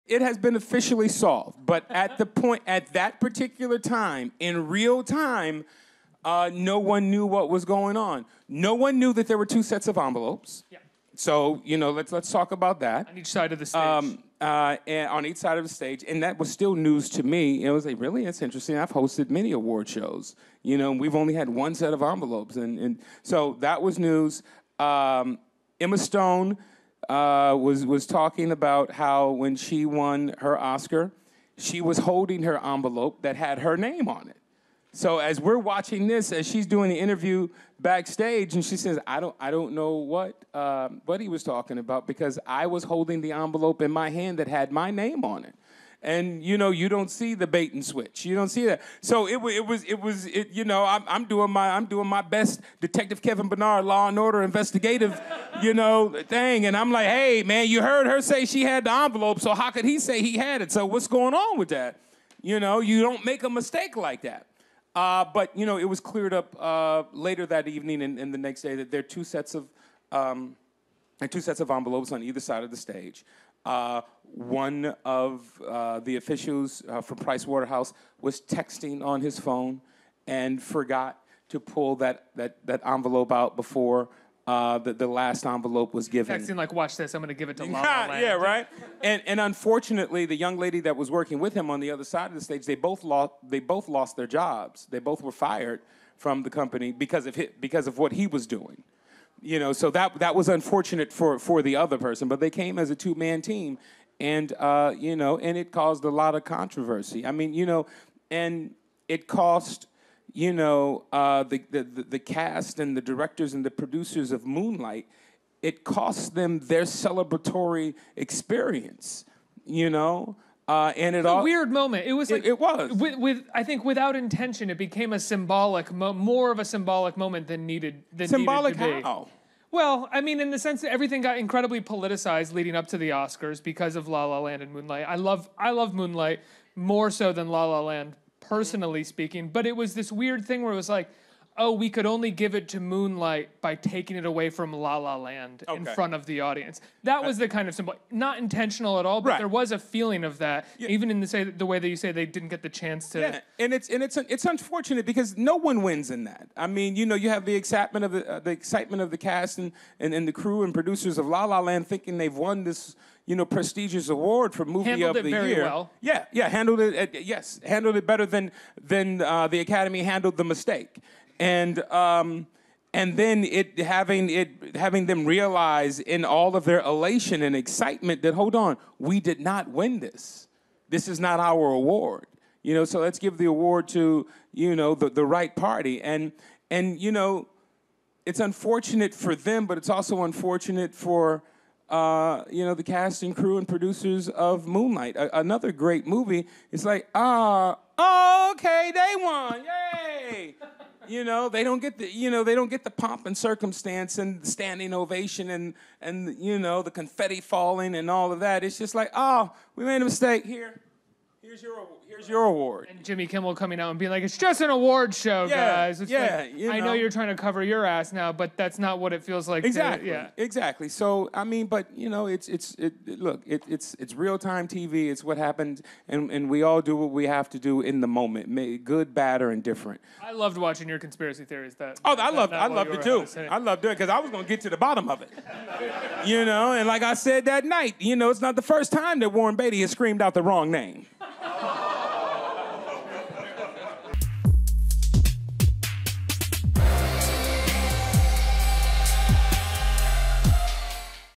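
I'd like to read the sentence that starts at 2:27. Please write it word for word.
That uh, was the kind of symbol, not intentional at all, but Right.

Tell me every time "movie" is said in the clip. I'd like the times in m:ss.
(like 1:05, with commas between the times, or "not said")
2:44, 3:16.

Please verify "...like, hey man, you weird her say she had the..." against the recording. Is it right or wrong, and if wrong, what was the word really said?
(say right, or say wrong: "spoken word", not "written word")
wrong: "heard", not "weird".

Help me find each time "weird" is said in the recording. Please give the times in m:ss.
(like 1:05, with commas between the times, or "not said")
2:01, 2:20.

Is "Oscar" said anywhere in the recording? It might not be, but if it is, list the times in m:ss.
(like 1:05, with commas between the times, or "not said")
0:30, 2:13.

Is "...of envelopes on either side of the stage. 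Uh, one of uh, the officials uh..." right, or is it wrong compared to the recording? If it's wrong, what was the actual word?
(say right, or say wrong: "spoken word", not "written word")
right.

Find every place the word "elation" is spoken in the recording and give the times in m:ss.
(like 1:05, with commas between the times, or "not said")
2:56.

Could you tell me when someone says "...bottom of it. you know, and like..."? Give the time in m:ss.
3:54.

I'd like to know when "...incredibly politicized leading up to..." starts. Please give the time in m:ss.
2:11.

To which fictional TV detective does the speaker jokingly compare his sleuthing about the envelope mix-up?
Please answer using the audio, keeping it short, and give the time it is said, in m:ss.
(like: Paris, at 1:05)
Kevin Bernard, at 0:52.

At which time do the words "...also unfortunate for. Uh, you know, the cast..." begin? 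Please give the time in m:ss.
3:09.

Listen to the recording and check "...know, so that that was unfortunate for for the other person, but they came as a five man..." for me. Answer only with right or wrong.
wrong.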